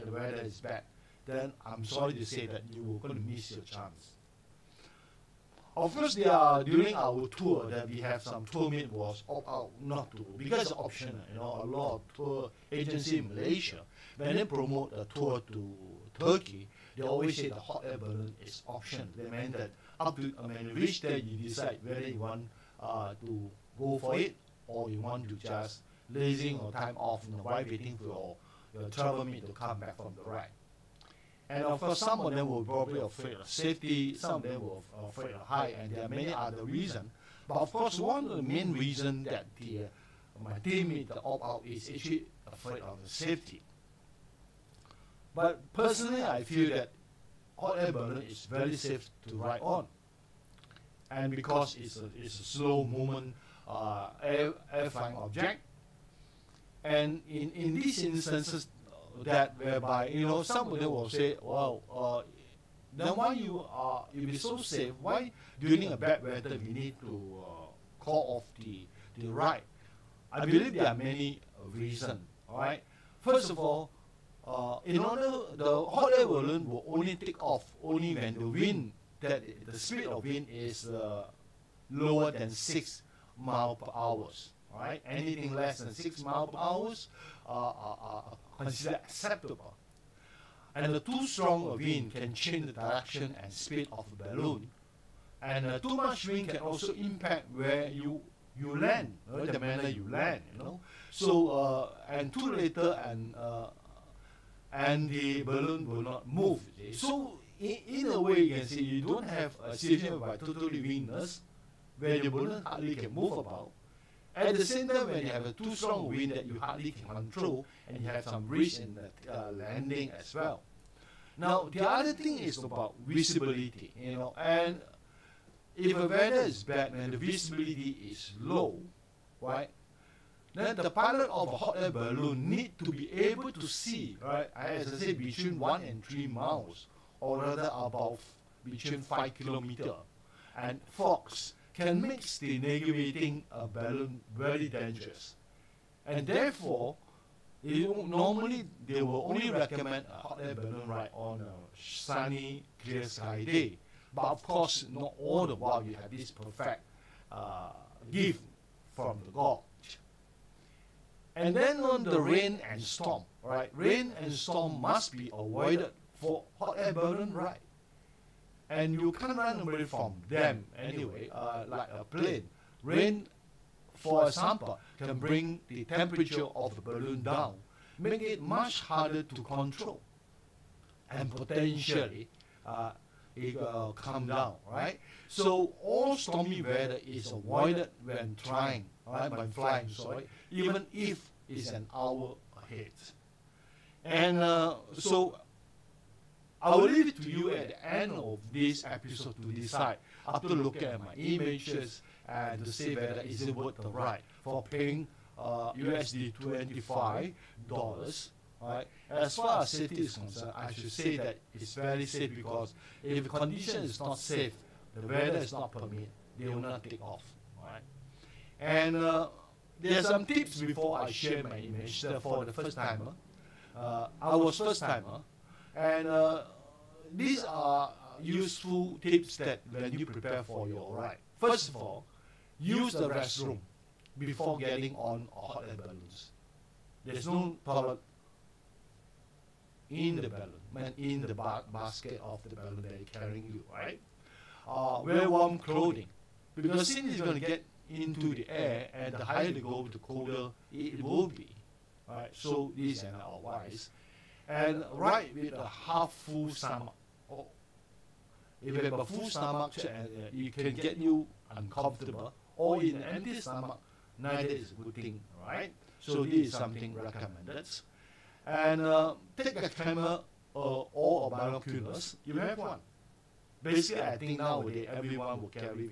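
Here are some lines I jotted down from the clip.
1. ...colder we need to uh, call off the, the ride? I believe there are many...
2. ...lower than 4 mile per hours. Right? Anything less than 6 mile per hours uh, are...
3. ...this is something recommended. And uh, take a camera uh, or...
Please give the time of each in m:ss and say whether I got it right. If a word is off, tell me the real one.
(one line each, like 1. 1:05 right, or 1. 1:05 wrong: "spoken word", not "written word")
1. 1:06 wrong: "weather", not "colder"
2. 1:21 wrong: "6", not "4"
3. 4:26 right.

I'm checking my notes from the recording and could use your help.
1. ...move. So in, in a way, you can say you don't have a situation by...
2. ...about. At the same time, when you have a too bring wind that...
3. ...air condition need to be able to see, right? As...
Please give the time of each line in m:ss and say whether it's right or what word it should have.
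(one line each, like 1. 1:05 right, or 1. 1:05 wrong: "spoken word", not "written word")
1. 1:46 right
2. 1:53 wrong: "strong", not "bring"
3. 2:11 wrong: "balloon", not "condition".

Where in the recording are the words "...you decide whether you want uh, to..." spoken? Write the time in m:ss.
0:21.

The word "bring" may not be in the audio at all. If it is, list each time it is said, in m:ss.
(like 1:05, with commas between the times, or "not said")
2:55.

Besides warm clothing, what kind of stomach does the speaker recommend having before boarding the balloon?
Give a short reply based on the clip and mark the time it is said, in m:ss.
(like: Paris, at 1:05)
half full stomach, at 4:15.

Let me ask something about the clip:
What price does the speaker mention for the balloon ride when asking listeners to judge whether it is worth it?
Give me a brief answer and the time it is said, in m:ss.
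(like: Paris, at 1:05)
USD $25, at 3:25.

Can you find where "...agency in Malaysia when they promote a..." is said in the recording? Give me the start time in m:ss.
0:12.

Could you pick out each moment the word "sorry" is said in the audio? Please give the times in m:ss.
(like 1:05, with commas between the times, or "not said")
0:01, 3:09.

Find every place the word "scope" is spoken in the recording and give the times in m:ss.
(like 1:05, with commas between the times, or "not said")
not said.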